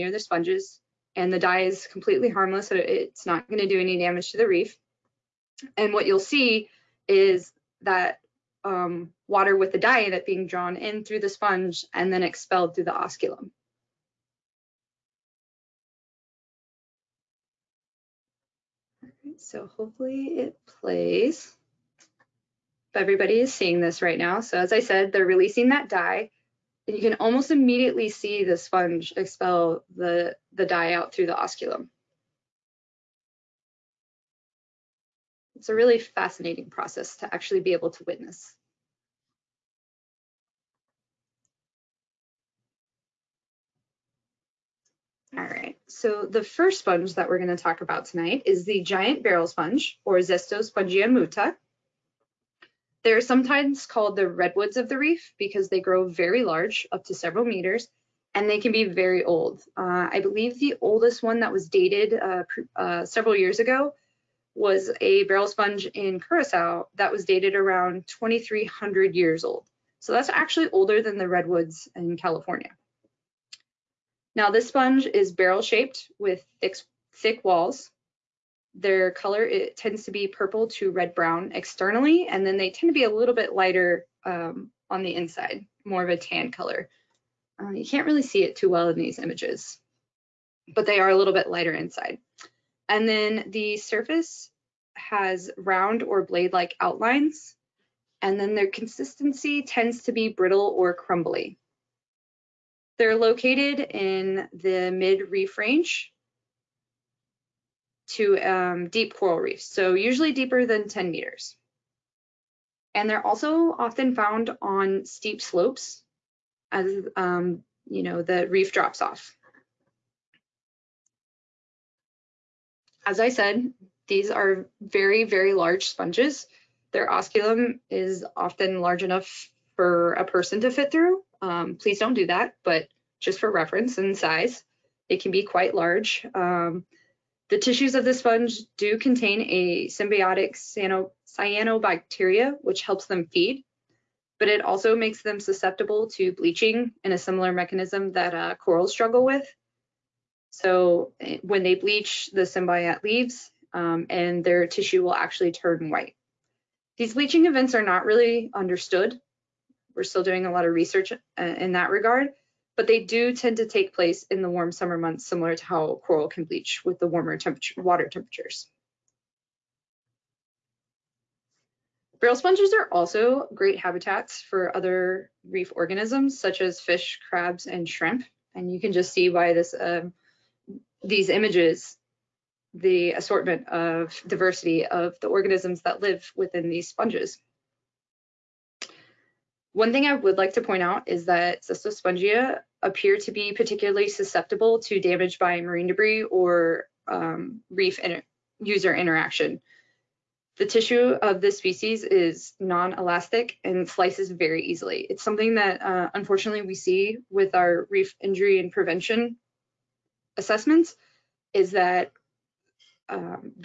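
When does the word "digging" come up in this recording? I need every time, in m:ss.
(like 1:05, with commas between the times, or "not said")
not said.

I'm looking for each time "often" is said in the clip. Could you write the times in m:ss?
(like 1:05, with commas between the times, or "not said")
1:53, 2:08.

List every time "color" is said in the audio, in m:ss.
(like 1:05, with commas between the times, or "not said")
1:19, 1:26.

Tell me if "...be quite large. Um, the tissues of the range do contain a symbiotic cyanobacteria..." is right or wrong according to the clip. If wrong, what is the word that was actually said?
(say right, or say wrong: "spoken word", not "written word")
wrong: "sponge", not "range".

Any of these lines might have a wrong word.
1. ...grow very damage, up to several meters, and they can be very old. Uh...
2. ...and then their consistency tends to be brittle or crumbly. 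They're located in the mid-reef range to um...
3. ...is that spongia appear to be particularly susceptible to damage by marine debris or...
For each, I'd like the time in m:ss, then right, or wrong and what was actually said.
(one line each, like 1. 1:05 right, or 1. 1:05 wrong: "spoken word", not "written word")
1. 0:55 wrong: "large", not "damage"
2. 1:38 right
3. 3:11 right.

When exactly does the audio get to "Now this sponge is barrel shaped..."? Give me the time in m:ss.
1:14.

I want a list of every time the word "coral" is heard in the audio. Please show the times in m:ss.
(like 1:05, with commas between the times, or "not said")
1:49, 2:28, 2:46.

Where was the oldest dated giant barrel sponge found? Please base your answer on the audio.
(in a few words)
Curacao.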